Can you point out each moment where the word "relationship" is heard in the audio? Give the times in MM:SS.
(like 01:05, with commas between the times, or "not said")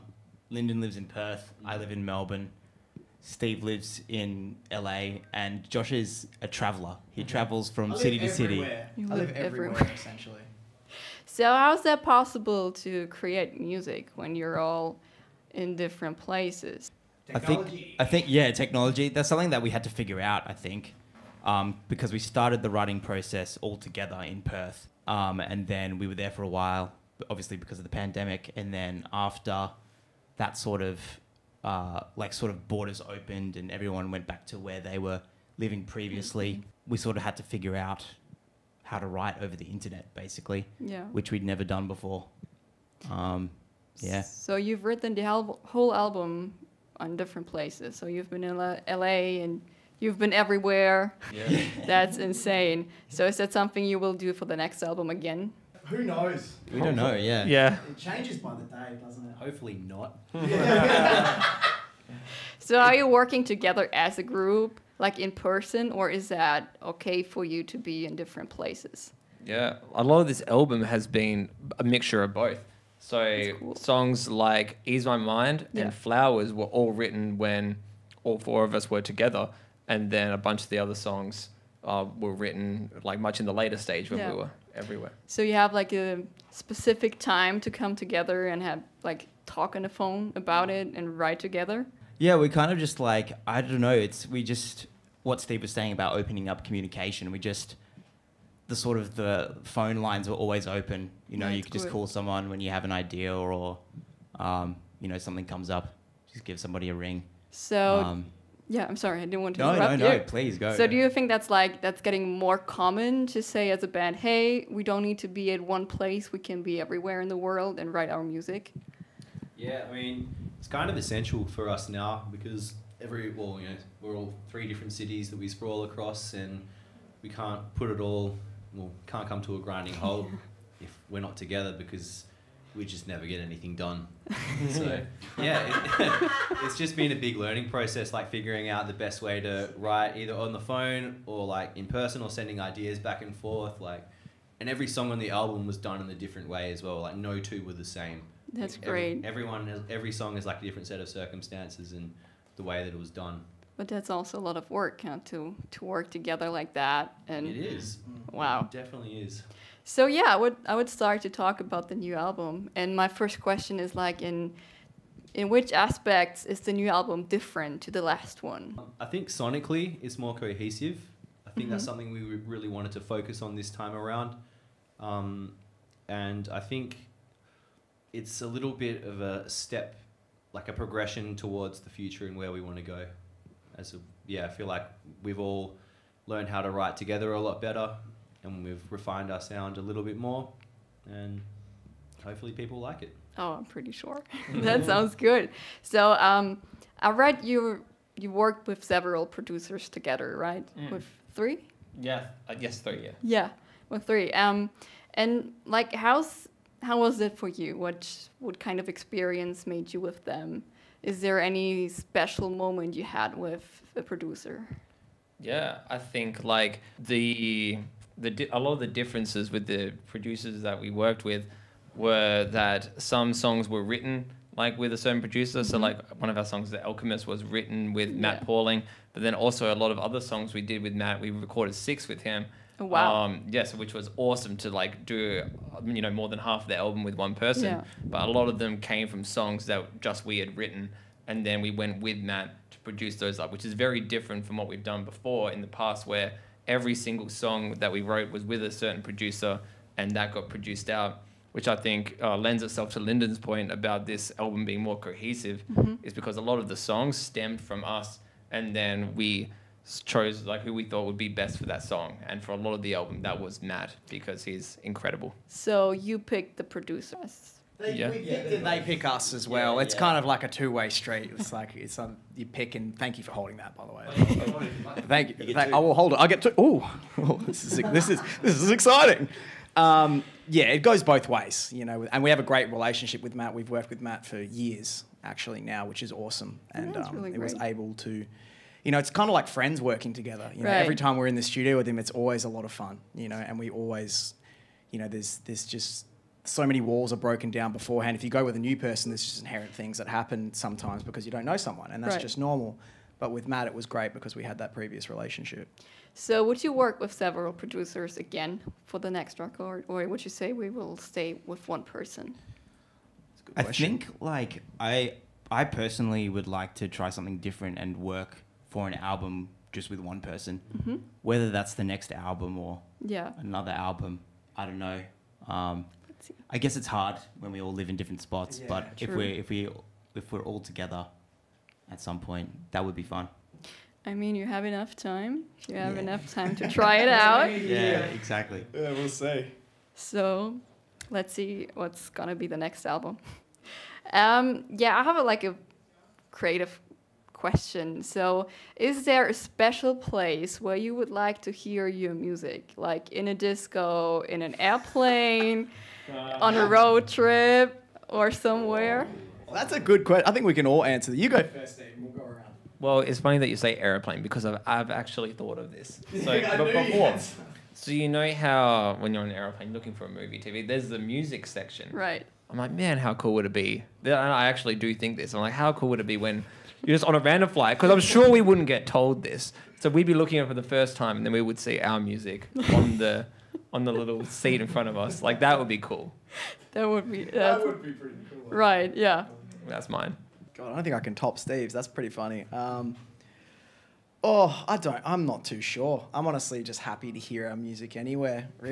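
04:42, 05:05.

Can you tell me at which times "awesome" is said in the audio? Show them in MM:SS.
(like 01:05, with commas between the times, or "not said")
03:54, 04:46.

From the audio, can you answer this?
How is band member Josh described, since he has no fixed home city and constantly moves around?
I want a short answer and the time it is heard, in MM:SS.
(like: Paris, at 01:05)
A traveler, at 00:06.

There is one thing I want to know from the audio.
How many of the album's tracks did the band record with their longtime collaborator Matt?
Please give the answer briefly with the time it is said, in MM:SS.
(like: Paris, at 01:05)
6, at 03:51.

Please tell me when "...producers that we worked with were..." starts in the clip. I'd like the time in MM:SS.
03:40.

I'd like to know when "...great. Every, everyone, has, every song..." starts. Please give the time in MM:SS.
02:28.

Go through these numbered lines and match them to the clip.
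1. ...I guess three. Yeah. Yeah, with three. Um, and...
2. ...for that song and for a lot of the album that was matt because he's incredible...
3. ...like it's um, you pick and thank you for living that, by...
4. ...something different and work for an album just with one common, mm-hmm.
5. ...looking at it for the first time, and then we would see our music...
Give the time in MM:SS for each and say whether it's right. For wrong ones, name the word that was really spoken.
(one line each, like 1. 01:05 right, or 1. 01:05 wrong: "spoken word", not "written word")
1. 03:22 right
2. 04:21 right
3. 04:31 wrong: "holding", not "living"
4. 05:17 wrong: "person", not "common"
5. 06:20 right.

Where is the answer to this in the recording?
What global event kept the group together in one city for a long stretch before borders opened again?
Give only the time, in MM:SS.
00:27.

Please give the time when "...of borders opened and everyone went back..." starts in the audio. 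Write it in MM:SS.
00:32.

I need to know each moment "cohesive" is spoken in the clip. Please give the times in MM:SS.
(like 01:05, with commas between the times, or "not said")
02:50, 04:14.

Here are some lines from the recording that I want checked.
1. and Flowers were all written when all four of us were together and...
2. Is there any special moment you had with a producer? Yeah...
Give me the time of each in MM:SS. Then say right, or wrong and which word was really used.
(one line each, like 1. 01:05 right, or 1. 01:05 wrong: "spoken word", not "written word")
1. 01:15 right
2. 03:31 right.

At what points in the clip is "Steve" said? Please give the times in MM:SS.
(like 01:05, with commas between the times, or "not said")
00:03, 01:35, 06:31.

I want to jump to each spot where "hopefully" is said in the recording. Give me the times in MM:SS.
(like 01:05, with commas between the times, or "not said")
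00:59, 03:12.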